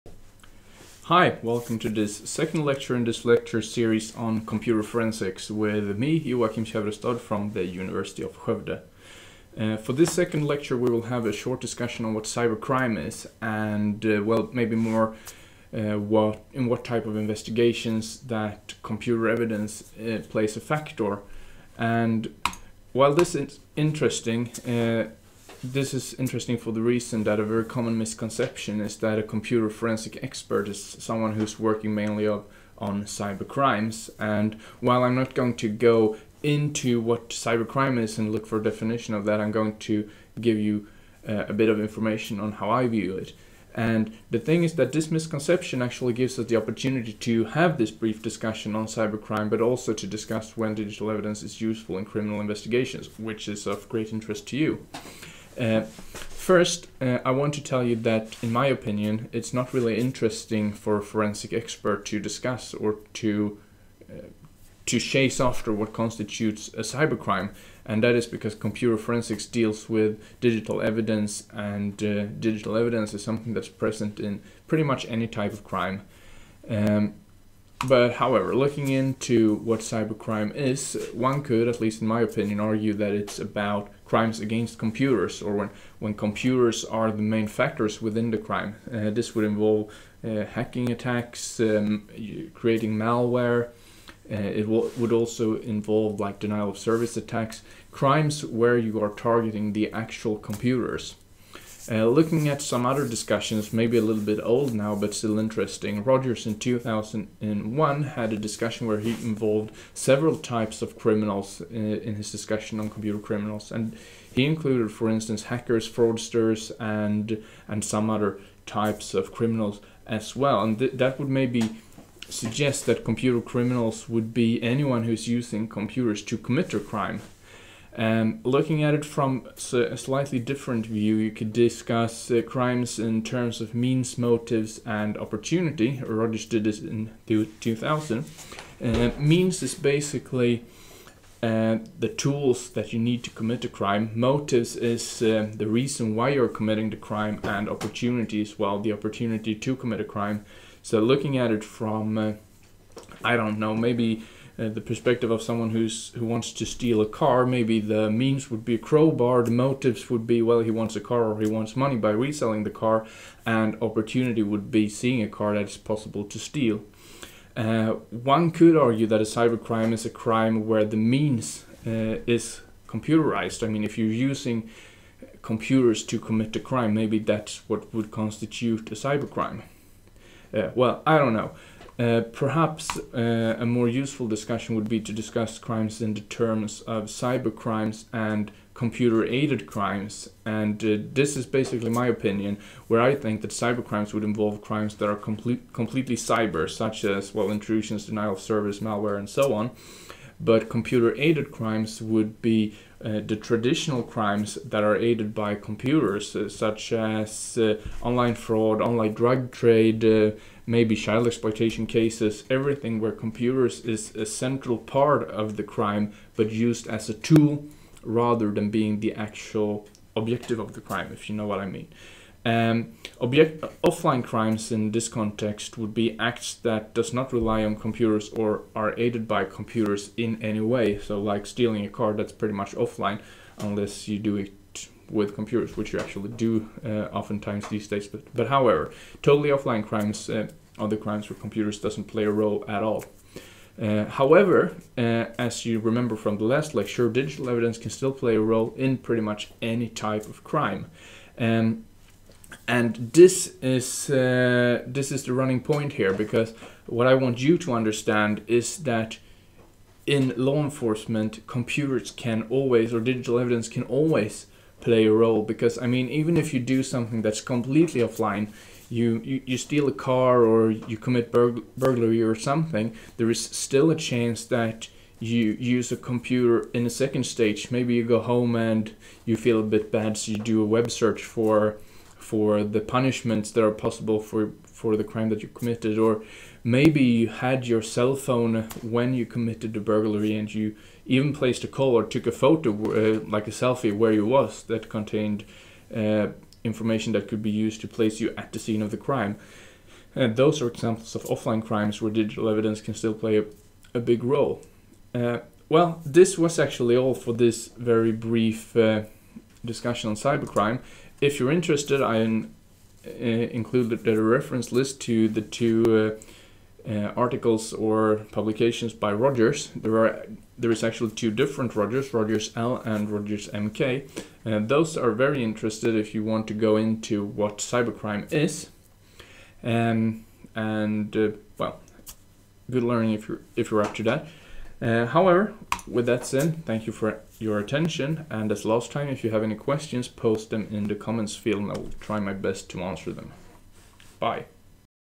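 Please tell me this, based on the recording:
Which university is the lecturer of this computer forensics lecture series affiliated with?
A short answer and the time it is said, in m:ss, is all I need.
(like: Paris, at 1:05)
University of Skövde, at 0:07.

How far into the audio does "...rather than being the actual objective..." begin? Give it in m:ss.
3:38.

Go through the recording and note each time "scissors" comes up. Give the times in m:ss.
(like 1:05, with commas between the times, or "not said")
not said.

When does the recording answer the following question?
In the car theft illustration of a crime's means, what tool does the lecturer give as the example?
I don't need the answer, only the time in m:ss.
2:38.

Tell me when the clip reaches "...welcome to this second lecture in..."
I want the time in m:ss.
0:01.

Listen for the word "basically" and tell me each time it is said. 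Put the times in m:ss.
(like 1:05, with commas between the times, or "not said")
2:19, 3:11.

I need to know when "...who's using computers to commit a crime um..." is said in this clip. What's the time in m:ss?
2:05.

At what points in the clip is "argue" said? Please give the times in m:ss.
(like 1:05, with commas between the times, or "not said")
1:22, 2:48.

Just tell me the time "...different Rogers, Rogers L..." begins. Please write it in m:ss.
5:21.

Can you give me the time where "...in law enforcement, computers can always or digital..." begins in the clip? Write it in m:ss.
4:20.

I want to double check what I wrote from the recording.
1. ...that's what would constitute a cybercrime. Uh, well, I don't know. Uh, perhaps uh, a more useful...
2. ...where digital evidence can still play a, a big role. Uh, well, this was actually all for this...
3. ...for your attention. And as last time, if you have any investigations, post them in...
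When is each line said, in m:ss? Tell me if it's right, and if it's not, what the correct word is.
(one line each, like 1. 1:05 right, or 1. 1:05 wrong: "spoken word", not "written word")
1. 2:57 right
2. 5:02 right
3. 5:36 wrong: "questions", not "investigations".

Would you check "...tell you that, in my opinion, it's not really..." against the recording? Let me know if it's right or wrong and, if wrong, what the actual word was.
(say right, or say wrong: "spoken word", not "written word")
right.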